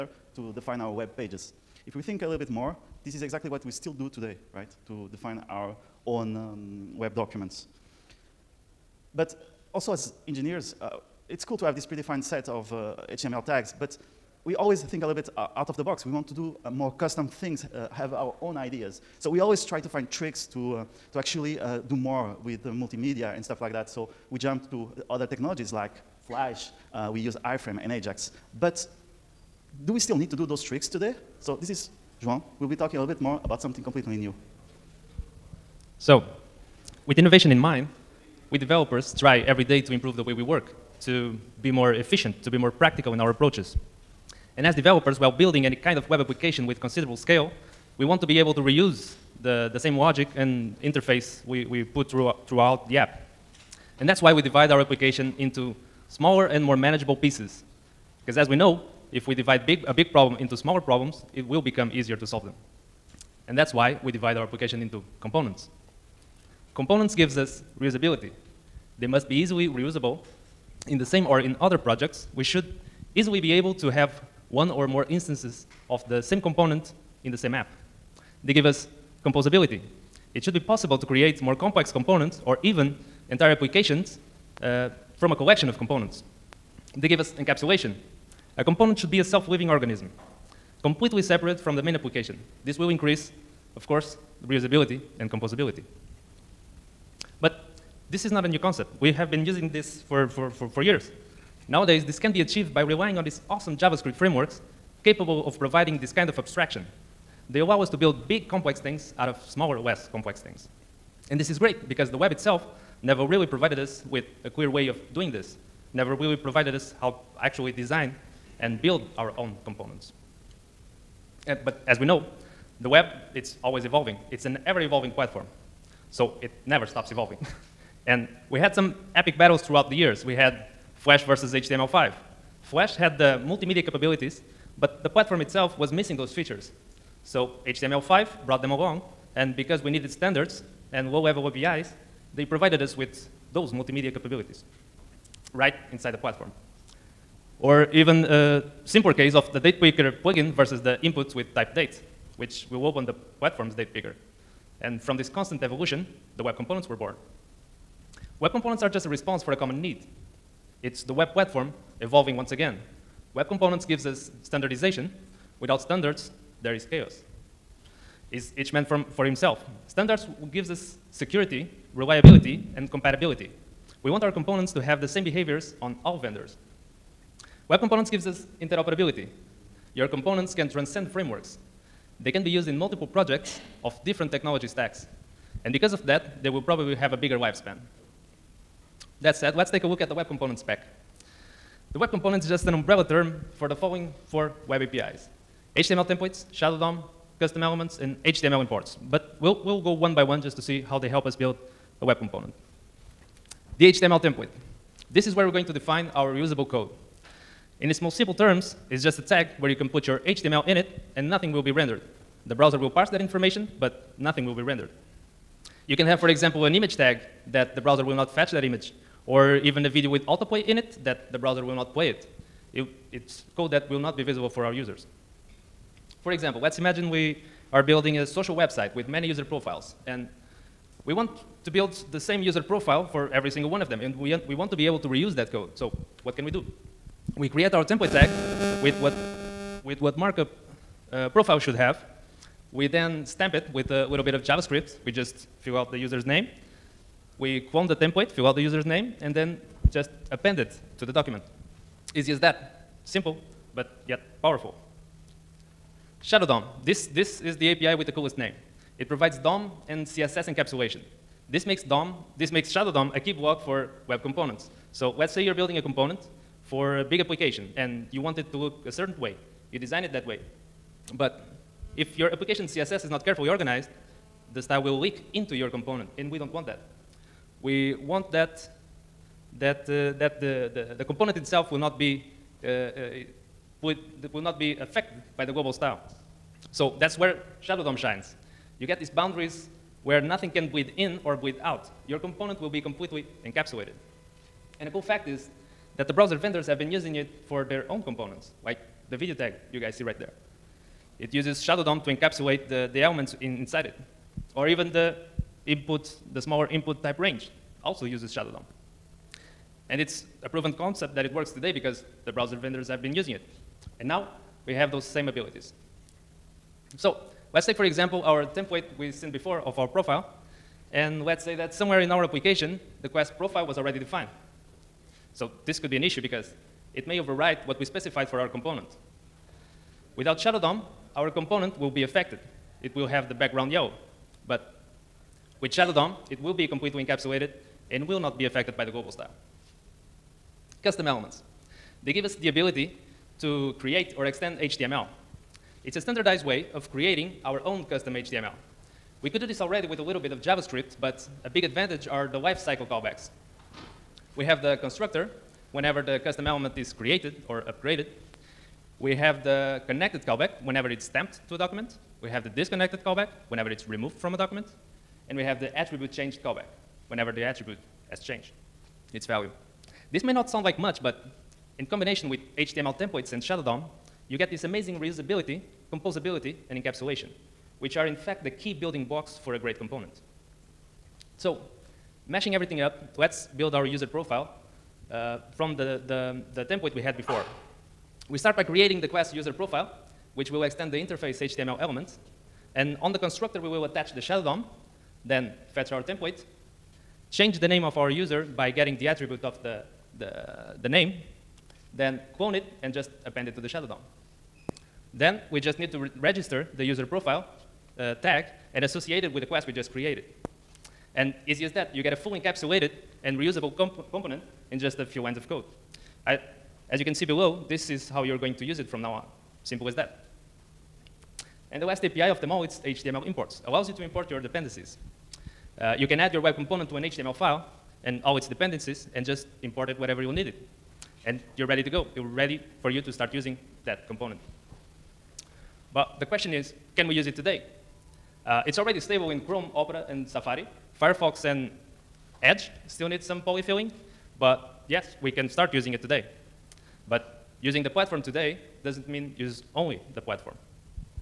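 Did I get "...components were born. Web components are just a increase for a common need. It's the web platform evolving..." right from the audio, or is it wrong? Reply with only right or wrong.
wrong.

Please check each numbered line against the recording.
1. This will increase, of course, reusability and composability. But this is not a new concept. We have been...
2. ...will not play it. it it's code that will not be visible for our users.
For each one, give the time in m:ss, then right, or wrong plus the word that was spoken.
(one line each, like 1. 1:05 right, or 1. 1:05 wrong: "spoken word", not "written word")
1. 1:32 right
2. 3:41 right.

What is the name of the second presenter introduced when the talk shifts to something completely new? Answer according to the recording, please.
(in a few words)
João.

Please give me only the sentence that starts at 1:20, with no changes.
It should be possible to create more complex components or even entire applications uh, from a collection of components.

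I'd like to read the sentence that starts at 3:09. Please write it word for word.
That said, let's take a look at the web component spec.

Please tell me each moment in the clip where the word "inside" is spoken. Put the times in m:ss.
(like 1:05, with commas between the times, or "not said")
2:25, 5:03.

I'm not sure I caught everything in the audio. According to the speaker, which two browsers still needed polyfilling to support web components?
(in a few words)
Firefox and Edge.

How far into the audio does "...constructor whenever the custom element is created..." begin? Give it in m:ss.
5:54.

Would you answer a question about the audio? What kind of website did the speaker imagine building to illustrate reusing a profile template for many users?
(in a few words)
social website.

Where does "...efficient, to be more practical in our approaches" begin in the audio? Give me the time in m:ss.
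0:41.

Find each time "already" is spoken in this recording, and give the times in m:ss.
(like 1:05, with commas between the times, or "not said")
5:23, 5:49, 7:18.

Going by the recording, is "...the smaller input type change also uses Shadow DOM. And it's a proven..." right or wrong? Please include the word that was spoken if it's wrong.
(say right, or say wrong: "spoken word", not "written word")
wrong: "range", not "change".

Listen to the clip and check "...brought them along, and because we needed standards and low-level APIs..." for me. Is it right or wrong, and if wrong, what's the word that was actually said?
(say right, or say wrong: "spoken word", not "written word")
right.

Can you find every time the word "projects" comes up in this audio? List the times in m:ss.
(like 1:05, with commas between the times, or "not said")
1:11, 3:03.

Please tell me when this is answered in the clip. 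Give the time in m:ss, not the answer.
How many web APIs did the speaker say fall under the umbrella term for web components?
3:14.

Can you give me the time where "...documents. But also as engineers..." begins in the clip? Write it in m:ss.
0:07.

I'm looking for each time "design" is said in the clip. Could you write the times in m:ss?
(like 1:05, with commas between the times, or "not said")
1:57, 4:29.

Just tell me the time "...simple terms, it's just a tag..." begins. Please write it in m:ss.
3:28.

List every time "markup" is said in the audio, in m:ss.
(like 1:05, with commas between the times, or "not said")
4:00.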